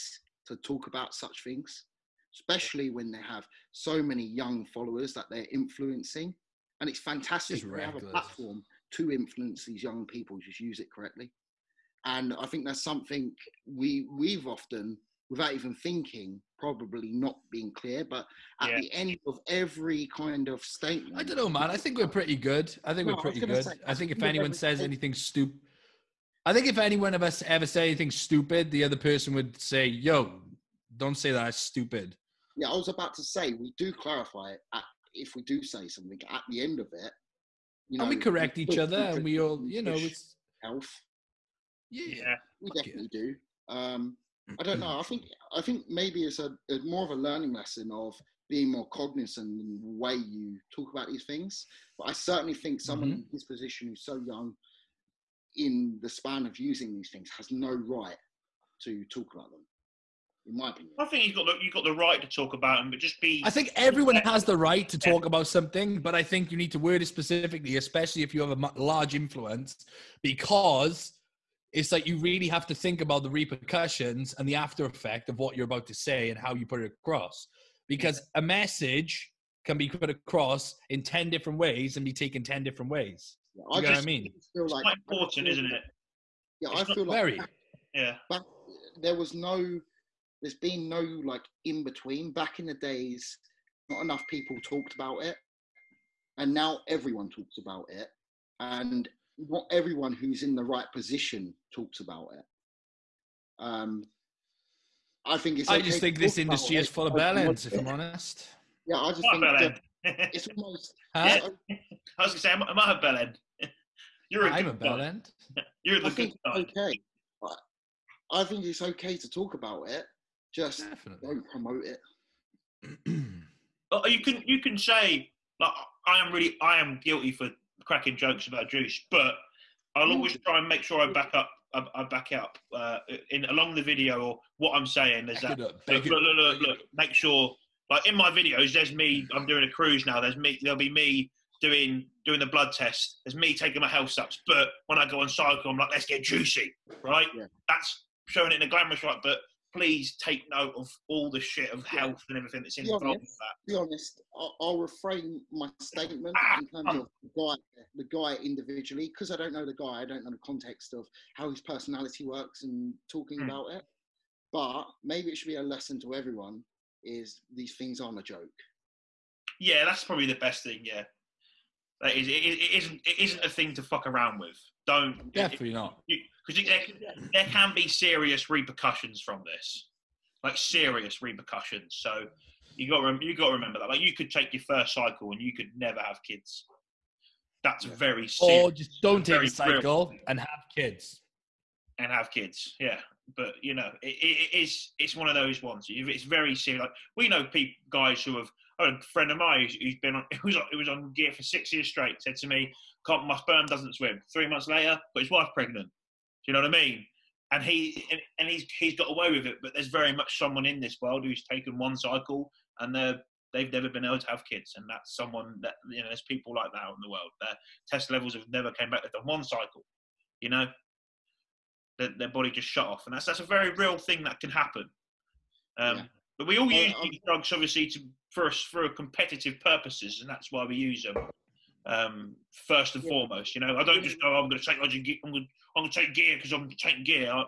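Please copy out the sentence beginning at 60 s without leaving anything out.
I think you've got the, you've got the right to talk about them, but just be.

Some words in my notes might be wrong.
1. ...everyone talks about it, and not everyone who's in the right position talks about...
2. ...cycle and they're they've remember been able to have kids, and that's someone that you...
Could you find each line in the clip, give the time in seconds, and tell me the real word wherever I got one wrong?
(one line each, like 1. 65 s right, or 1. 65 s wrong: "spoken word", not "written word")
1. 96 s right
2. 211 s wrong: "never", not "remember".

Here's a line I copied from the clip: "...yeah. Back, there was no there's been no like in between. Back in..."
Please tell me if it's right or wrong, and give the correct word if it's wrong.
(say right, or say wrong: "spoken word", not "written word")
right.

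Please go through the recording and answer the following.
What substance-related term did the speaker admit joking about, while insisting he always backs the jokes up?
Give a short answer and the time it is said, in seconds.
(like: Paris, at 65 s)
Juice, at 128 s.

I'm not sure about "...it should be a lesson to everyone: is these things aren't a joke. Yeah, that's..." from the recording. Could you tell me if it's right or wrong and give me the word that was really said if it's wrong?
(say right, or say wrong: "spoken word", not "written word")
right.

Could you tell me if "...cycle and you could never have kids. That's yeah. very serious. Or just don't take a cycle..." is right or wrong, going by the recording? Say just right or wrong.
right.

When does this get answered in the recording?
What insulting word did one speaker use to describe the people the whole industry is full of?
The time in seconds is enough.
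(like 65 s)
107 s.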